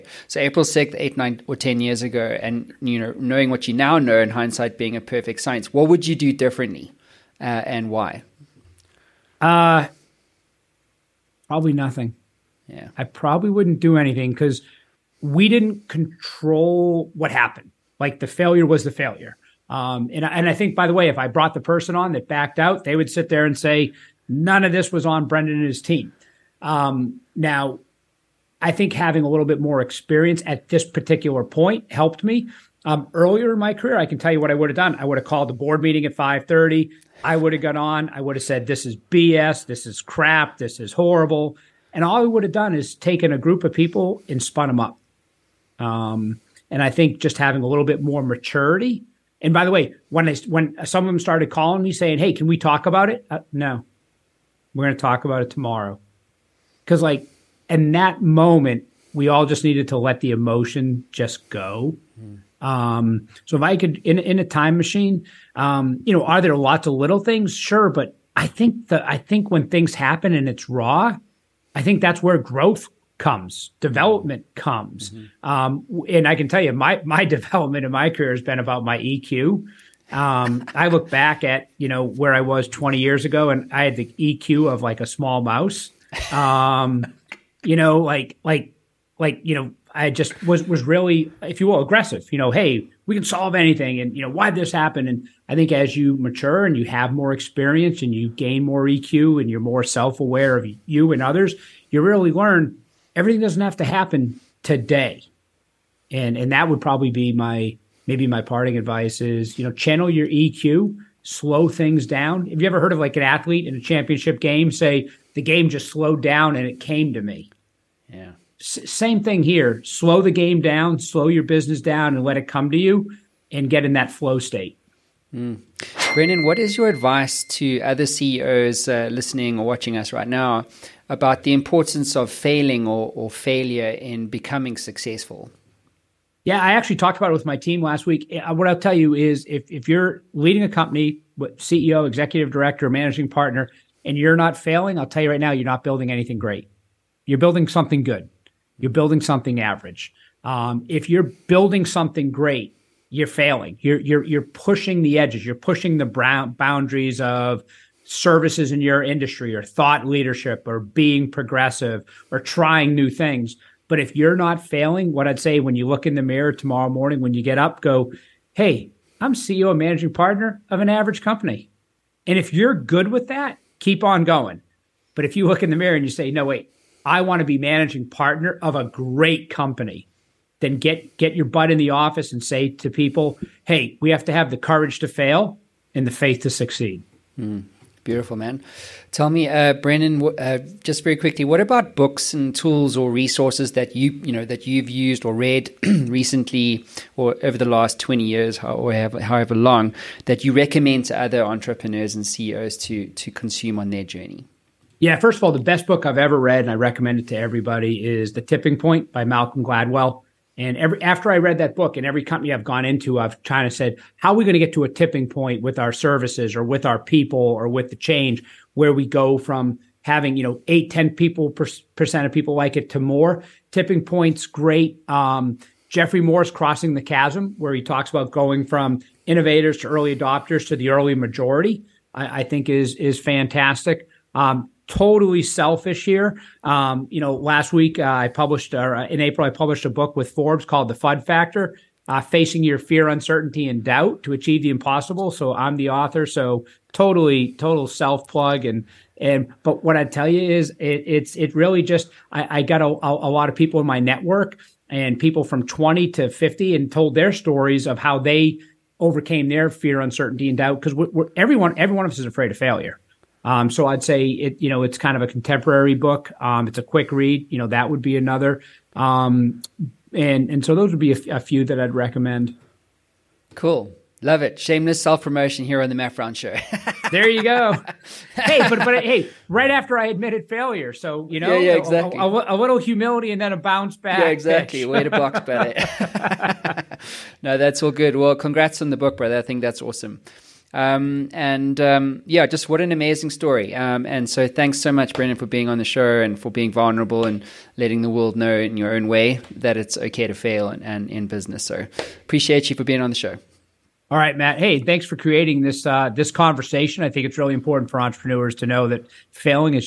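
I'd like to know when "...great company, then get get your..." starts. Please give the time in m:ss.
2:58.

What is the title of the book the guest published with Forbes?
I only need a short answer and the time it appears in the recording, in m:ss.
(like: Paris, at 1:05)
The FUD Factor, at 4:00.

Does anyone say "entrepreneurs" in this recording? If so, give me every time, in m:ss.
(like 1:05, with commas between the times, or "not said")
3:21, 5:07.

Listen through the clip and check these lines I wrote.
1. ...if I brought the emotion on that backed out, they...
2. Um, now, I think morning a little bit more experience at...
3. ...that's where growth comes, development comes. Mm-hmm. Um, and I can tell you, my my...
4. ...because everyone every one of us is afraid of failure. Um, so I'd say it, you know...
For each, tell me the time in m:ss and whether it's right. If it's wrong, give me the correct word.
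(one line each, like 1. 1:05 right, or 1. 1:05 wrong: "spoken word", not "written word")
1. 0:21 wrong: "person", not "emotion"
2. 0:26 wrong: "having", not "morning"
3. 1:12 right
4. 4:20 right.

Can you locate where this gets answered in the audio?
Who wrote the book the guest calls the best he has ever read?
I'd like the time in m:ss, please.
3:29.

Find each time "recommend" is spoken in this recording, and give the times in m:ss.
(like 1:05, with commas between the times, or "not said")
3:20, 3:26, 4:31.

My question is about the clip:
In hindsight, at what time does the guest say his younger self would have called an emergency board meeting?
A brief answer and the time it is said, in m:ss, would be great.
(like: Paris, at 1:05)
5:30, at 0:36.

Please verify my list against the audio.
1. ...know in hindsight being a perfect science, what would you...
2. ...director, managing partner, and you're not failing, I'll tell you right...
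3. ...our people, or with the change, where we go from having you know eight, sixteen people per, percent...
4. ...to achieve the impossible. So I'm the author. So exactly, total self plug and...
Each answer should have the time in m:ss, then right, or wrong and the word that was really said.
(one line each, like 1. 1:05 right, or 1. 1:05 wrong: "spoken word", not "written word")
1. 0:03 right
2. 2:22 right
3. 3:36 wrong: "ten", not "sixteen"
4. 4:04 wrong: "totally", not "exactly".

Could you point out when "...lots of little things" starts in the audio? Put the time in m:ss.
1:06.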